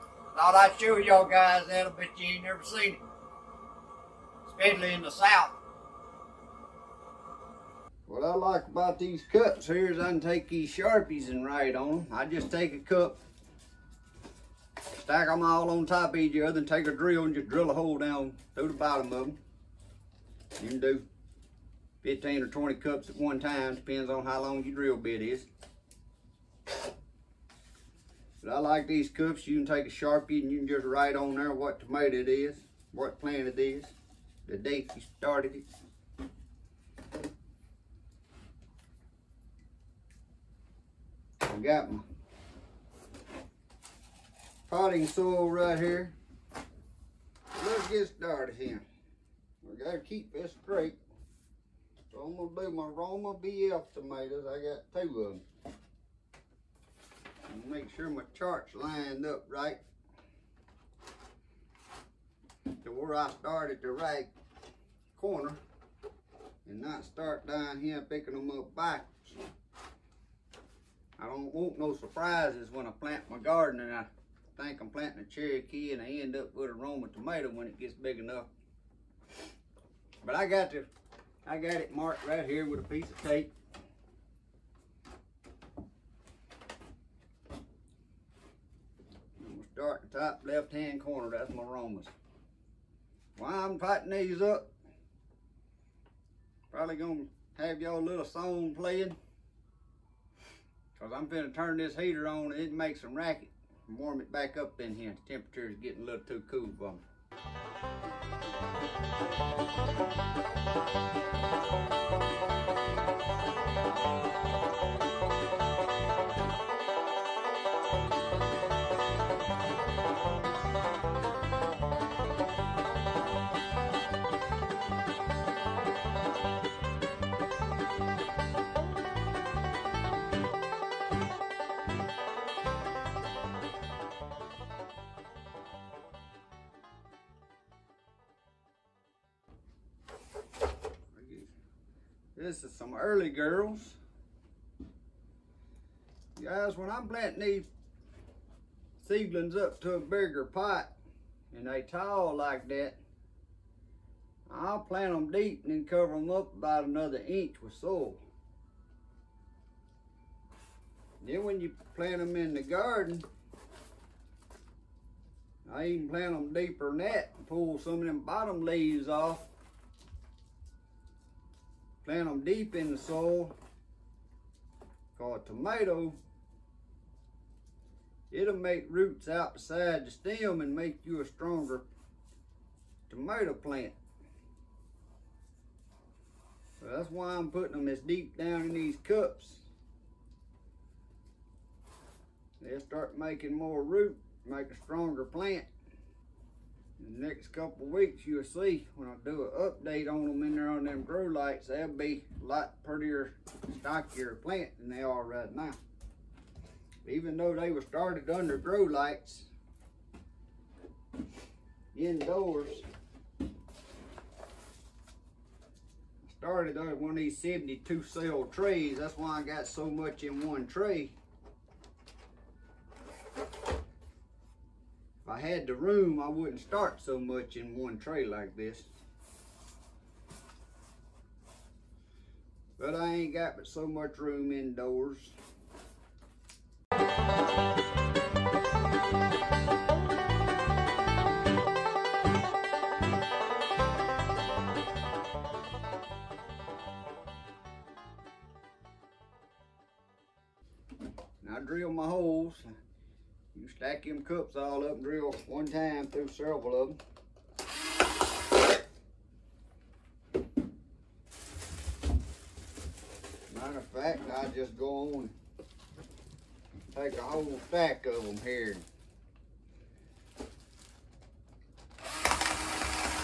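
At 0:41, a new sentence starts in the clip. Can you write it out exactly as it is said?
I got my potting soil right here.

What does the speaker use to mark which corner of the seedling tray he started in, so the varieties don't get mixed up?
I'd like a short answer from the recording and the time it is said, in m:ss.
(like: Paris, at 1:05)
A piece of tape, at 1:22.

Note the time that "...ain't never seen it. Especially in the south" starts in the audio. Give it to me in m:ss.
0:02.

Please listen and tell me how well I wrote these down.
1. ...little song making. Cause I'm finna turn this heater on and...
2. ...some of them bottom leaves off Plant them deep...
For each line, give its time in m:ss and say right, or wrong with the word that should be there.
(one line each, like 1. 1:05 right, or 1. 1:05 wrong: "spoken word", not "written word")
1. 1:38 wrong: "playing", not "making"
2. 2:47 right.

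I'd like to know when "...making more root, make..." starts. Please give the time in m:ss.
3:13.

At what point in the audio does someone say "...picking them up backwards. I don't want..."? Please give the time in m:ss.
1:08.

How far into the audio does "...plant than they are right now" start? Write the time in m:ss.
3:24.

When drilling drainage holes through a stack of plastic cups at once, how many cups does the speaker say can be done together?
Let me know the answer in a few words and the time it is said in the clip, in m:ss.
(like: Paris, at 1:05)
15 or 20, at 0:22.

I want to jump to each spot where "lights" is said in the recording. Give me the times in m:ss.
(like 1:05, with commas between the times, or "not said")
3:21, 3:28.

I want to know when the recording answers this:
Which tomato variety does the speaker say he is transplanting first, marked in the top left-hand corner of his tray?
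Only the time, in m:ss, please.
0:52.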